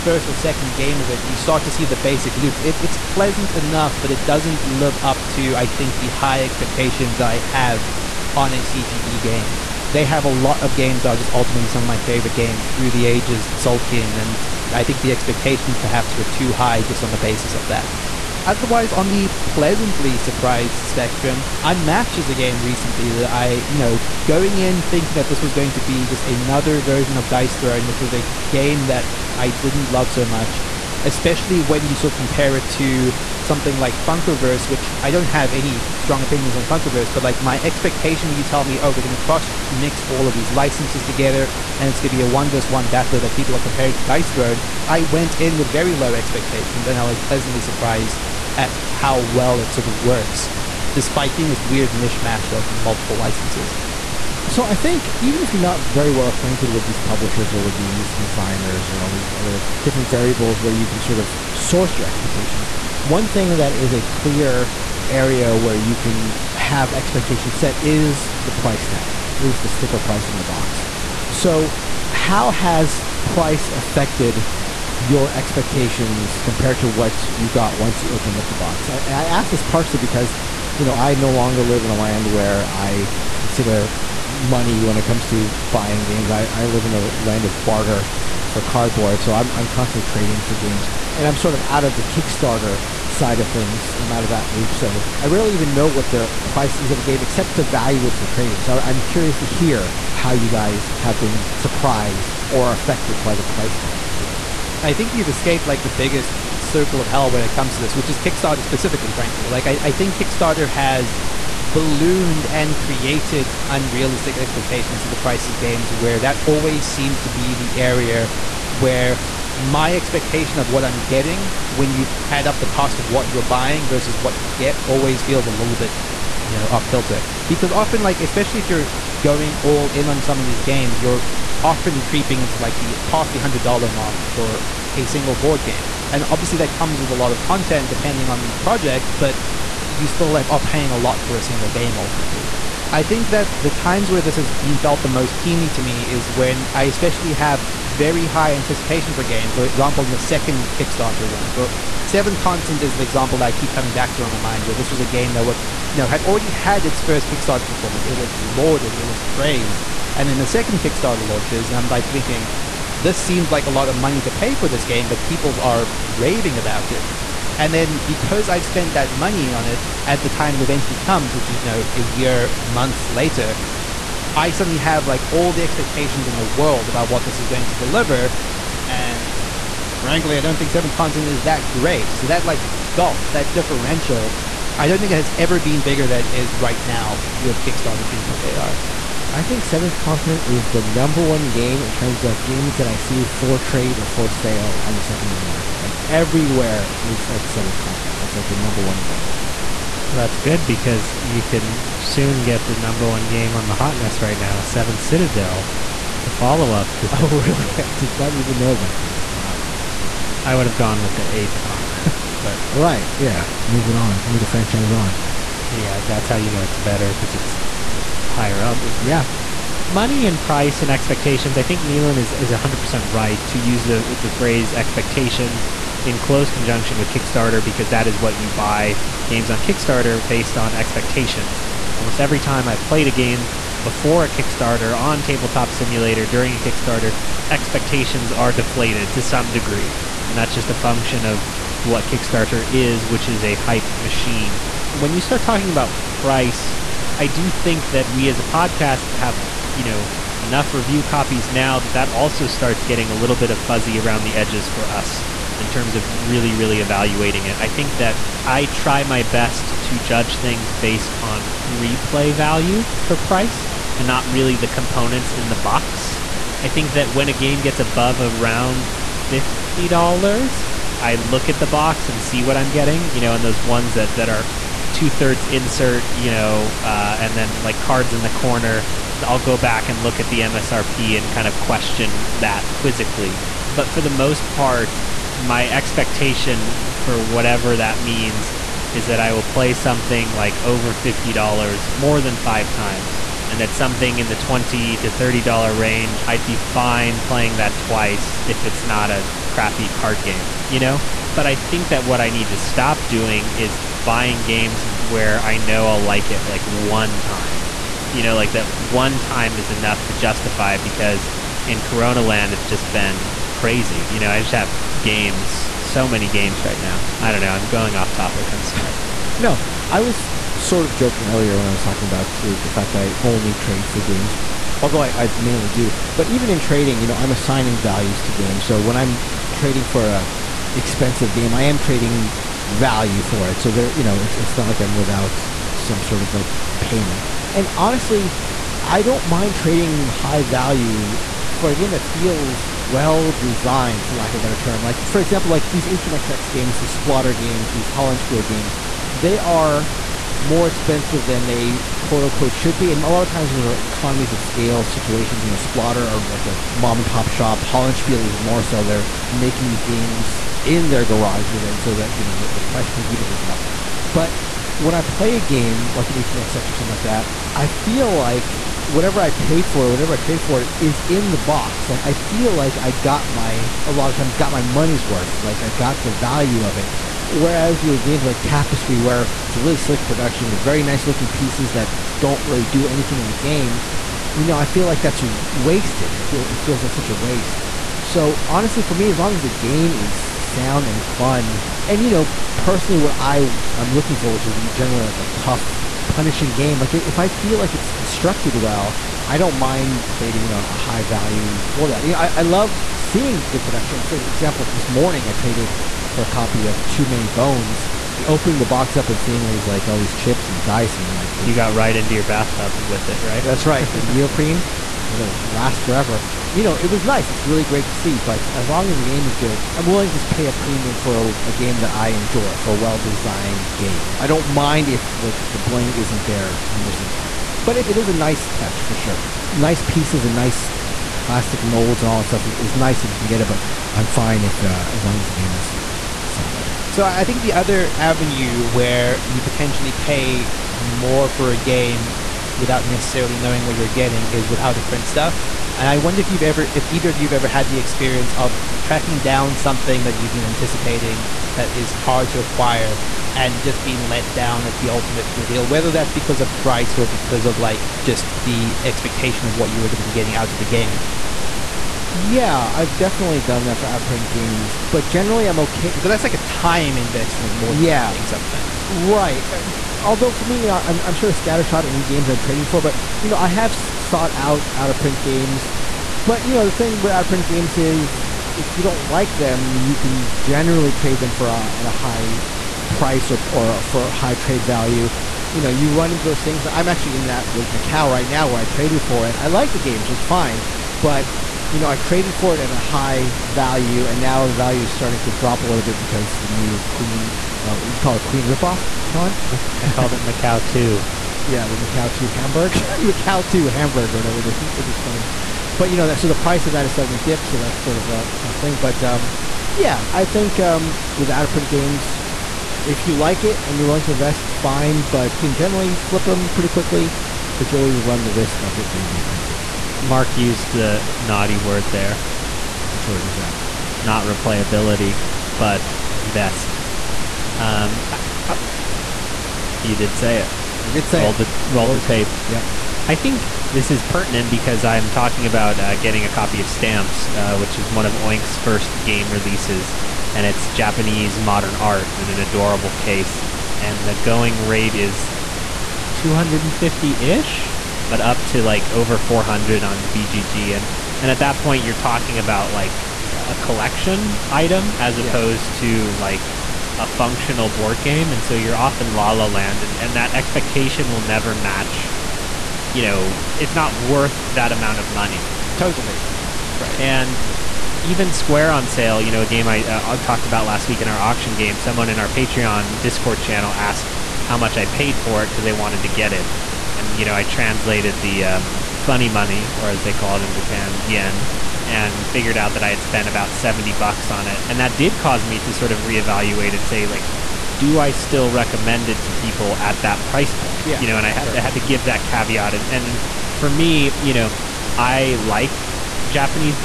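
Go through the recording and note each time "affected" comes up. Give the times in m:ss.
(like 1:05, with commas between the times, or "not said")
1:13, 1:42.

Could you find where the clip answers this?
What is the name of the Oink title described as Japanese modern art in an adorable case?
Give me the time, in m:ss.
8:56.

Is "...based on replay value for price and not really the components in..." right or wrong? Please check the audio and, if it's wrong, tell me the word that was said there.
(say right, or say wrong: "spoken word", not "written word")
right.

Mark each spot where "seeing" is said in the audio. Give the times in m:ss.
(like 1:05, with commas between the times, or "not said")
6:42, 6:49.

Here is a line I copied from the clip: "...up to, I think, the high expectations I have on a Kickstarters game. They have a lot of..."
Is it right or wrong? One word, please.
wrong.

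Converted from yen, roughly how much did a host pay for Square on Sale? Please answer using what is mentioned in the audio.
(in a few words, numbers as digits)
70 bucks.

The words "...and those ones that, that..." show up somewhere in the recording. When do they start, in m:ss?
4:33.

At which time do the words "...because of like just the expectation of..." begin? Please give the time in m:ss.
7:37.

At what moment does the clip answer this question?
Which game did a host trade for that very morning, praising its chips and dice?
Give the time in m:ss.
6:46.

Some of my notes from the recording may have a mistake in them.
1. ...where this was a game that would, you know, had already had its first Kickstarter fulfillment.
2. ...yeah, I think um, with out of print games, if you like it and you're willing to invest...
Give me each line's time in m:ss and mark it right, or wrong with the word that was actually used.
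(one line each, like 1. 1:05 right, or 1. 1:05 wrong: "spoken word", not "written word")
1. 2:34 right
2. 8:29 right.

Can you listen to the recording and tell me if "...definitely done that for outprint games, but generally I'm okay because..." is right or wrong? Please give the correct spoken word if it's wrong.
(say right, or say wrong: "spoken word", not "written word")
right.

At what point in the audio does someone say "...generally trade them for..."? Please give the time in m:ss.
8:00.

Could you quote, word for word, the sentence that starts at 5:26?
But even in trading, you know, I'm assigning values to games.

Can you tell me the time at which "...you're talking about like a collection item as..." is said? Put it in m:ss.
9:11.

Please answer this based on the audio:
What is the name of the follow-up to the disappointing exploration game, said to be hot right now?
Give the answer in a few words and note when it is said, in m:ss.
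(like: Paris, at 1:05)
Seven Citadel, at 3:24.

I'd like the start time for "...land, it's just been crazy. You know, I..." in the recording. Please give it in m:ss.
5:12.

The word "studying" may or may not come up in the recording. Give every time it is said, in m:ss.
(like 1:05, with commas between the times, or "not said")
not said.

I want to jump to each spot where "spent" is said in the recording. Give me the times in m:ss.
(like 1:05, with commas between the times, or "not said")
2:48, 9:43.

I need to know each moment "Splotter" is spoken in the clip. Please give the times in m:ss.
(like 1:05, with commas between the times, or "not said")
5:46, 5:55.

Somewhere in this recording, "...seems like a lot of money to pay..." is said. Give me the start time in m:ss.
2:43.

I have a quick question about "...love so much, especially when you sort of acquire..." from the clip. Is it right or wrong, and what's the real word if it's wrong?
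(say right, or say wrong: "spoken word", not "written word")
wrong: "compare", not "acquire".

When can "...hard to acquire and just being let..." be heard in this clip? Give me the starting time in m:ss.
7:31.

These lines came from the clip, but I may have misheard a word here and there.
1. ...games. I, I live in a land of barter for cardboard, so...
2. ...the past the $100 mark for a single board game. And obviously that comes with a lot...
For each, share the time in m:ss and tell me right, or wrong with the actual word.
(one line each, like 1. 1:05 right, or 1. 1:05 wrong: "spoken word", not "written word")
1. 1:26 right
2. 2:12 right.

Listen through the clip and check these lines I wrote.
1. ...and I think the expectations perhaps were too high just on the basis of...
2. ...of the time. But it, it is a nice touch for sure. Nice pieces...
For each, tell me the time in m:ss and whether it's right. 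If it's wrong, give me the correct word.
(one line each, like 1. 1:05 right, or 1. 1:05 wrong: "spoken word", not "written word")
1. 0:14 right
2. 7:06 right.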